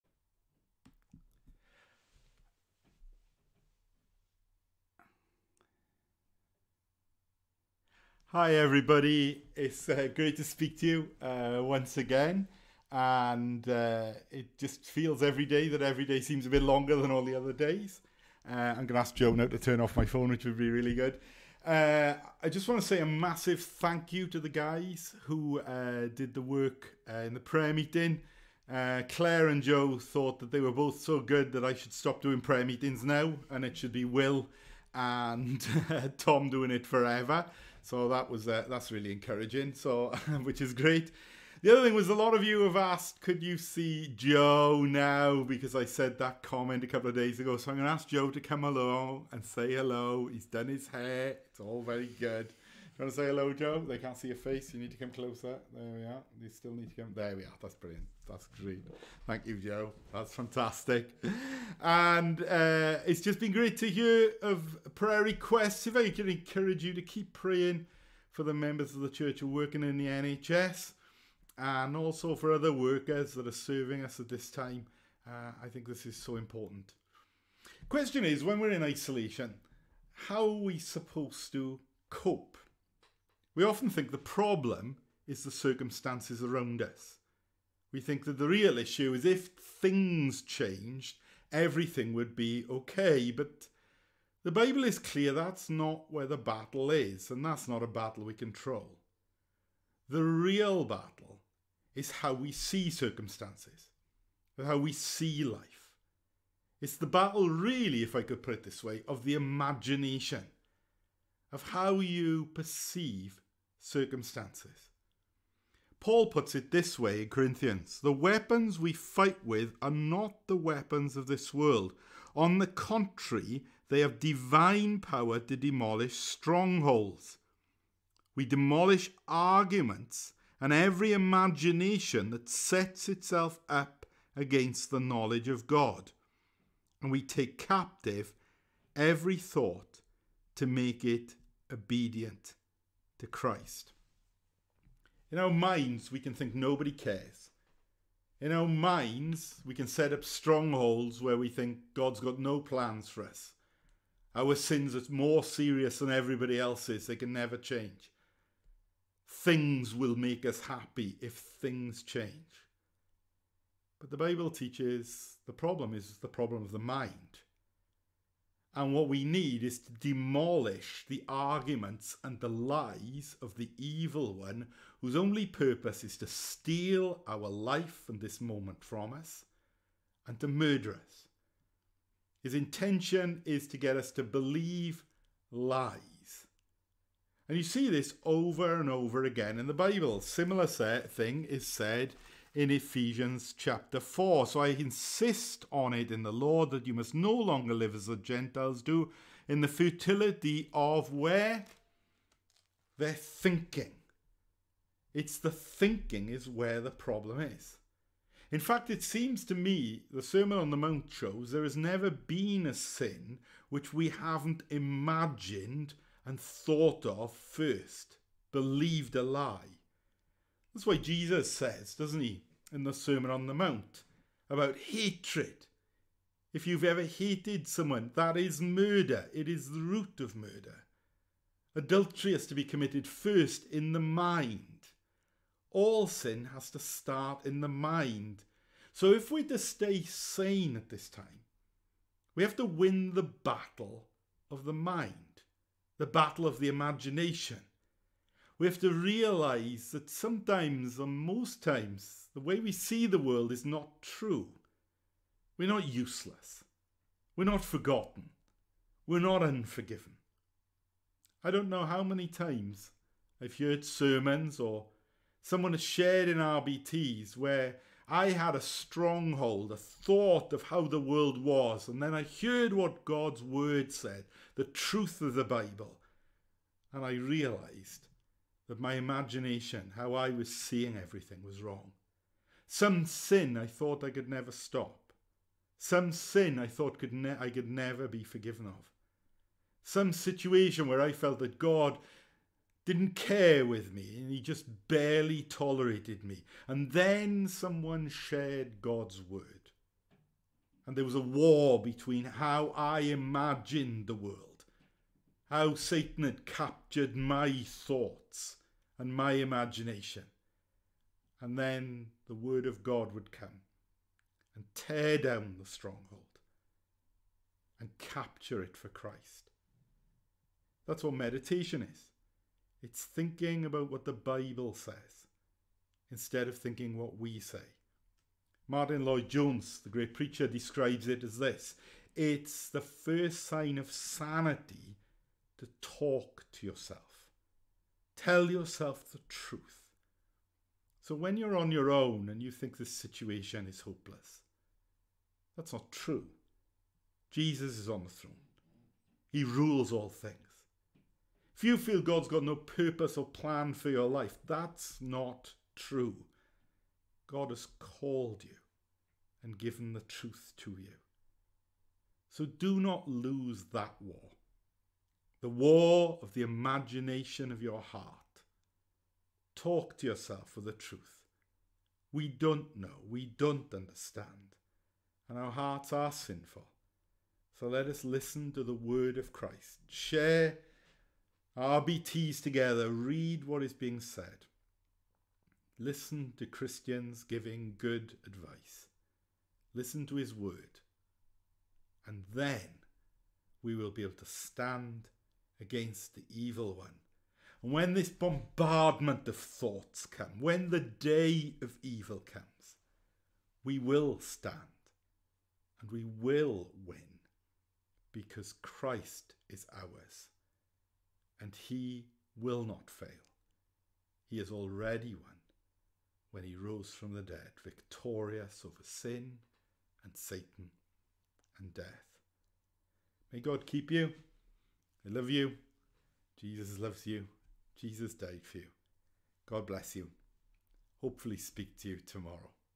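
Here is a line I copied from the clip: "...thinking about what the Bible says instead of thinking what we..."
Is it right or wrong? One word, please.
right.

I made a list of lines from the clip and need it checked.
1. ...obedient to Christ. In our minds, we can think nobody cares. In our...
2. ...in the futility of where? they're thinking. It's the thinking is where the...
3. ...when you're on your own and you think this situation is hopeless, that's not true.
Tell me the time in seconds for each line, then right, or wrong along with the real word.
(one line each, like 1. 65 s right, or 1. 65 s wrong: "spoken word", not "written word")
1. 141 s right
2. 199 s right
3. 341 s right.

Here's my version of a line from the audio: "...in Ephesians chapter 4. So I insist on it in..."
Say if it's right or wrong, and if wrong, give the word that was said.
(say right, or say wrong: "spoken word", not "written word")
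right.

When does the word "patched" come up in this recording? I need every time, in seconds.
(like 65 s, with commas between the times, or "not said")
not said.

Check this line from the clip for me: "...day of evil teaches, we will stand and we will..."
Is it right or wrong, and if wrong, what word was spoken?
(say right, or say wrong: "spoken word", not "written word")
wrong: "comes", not "teaches".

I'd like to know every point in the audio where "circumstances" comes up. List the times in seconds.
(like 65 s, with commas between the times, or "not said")
85 s, 102 s, 113 s.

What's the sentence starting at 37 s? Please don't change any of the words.
So that was uh, that's really encouraging.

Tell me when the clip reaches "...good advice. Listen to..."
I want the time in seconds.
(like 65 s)
387 s.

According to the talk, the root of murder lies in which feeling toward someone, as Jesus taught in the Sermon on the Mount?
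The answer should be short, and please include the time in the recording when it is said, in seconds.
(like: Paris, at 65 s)
Hatred, at 224 s.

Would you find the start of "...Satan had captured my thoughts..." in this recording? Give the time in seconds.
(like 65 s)
305 s.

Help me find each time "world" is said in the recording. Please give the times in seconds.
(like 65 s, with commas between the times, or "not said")
121 s, 253 s, 271 s, 304 s.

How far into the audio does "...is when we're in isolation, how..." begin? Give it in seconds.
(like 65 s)
78 s.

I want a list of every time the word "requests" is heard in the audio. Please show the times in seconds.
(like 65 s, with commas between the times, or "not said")
65 s.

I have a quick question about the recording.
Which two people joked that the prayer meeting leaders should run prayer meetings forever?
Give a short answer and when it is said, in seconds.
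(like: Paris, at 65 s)
Claire and Joe, at 29 s.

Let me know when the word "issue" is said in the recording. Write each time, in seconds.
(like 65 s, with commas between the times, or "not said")
88 s.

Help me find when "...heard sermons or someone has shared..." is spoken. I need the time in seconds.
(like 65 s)
263 s.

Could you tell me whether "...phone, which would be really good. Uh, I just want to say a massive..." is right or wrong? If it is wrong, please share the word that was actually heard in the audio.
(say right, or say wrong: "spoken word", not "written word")
right.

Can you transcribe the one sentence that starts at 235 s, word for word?
All sin has to start in the mind.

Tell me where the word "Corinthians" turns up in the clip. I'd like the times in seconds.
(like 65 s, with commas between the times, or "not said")
117 s.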